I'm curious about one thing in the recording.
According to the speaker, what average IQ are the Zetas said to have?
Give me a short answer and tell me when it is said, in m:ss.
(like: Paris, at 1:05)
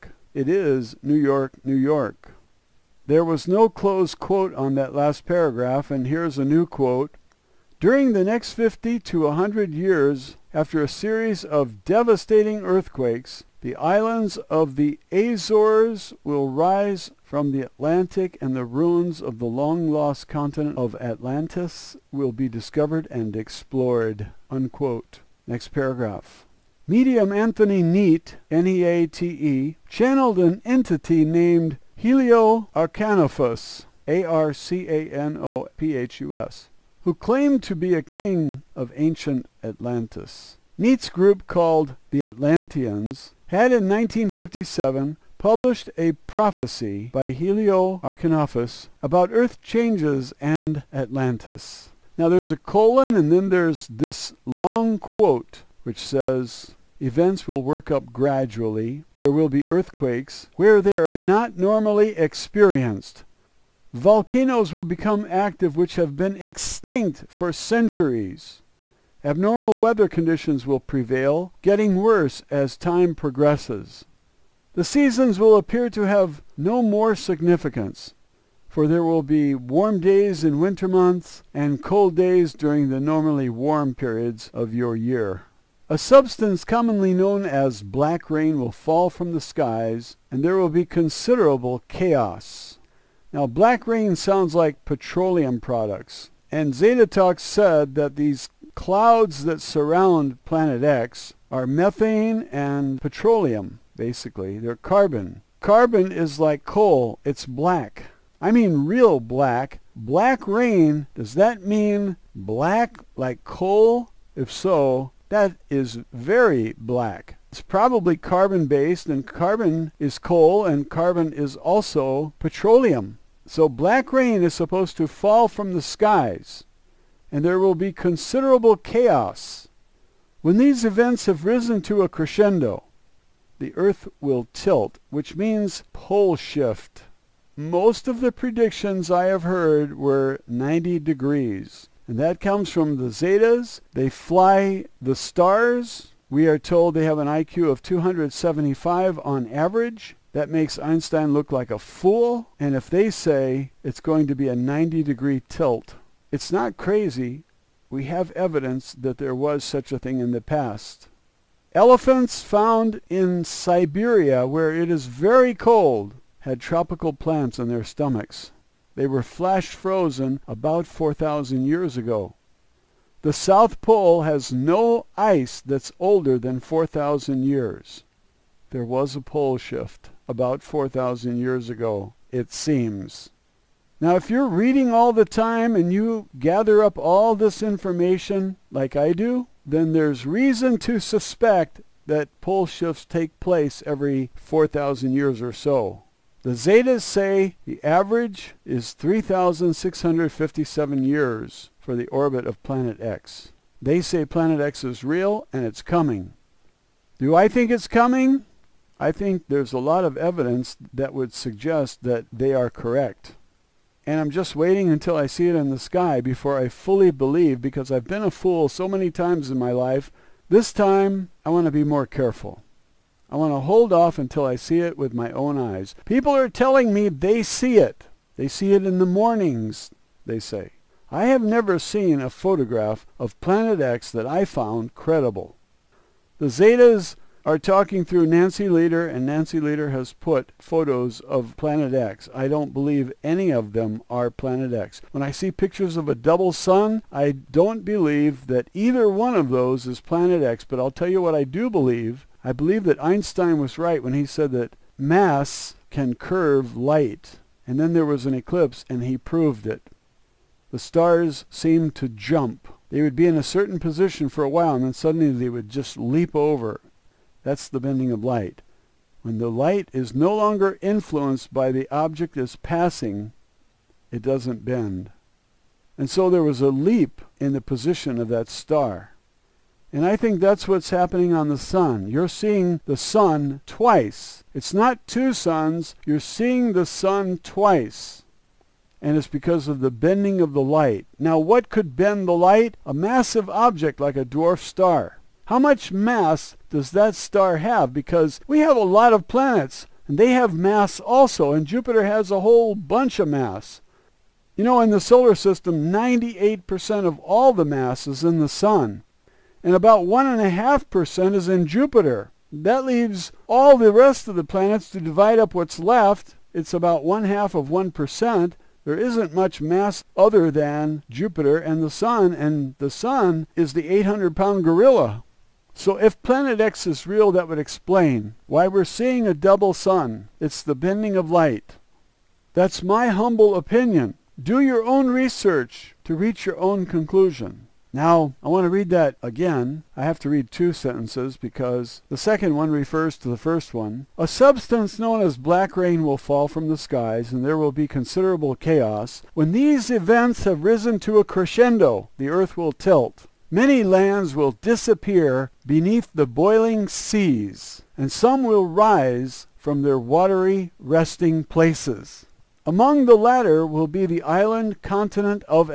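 275, at 2:27.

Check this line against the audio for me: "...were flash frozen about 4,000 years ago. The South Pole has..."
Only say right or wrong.
right.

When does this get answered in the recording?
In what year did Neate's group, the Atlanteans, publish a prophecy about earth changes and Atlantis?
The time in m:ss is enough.
0:43.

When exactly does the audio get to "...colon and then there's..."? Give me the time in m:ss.
0:52.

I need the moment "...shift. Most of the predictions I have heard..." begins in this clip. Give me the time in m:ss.
2:16.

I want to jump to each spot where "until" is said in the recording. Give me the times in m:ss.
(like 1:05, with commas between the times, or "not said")
3:34, 3:44.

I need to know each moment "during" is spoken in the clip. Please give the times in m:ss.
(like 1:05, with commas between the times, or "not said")
0:07, 1:22.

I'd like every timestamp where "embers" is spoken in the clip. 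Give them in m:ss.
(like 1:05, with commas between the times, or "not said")
not said.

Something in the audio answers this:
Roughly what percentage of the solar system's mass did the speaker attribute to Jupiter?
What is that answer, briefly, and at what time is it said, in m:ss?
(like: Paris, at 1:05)
1.5%, at 5:10.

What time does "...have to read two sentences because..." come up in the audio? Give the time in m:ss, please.
5:40.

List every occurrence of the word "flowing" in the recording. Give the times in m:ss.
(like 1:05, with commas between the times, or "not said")
not said.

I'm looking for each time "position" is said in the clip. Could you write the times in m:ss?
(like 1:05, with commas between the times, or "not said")
4:23, 4:37.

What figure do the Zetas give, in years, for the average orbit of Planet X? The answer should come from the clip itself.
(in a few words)
3,657.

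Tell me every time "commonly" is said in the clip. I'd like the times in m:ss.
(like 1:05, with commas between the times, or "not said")
1:26.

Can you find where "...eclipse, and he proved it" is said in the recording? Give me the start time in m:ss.
4:18.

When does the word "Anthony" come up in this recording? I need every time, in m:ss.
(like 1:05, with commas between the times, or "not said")
0:27.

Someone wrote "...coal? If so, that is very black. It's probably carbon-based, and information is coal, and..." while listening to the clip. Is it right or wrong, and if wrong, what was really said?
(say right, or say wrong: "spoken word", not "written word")
wrong: "carbon", not "information".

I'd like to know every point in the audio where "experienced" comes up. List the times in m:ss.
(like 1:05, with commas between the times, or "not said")
1:02.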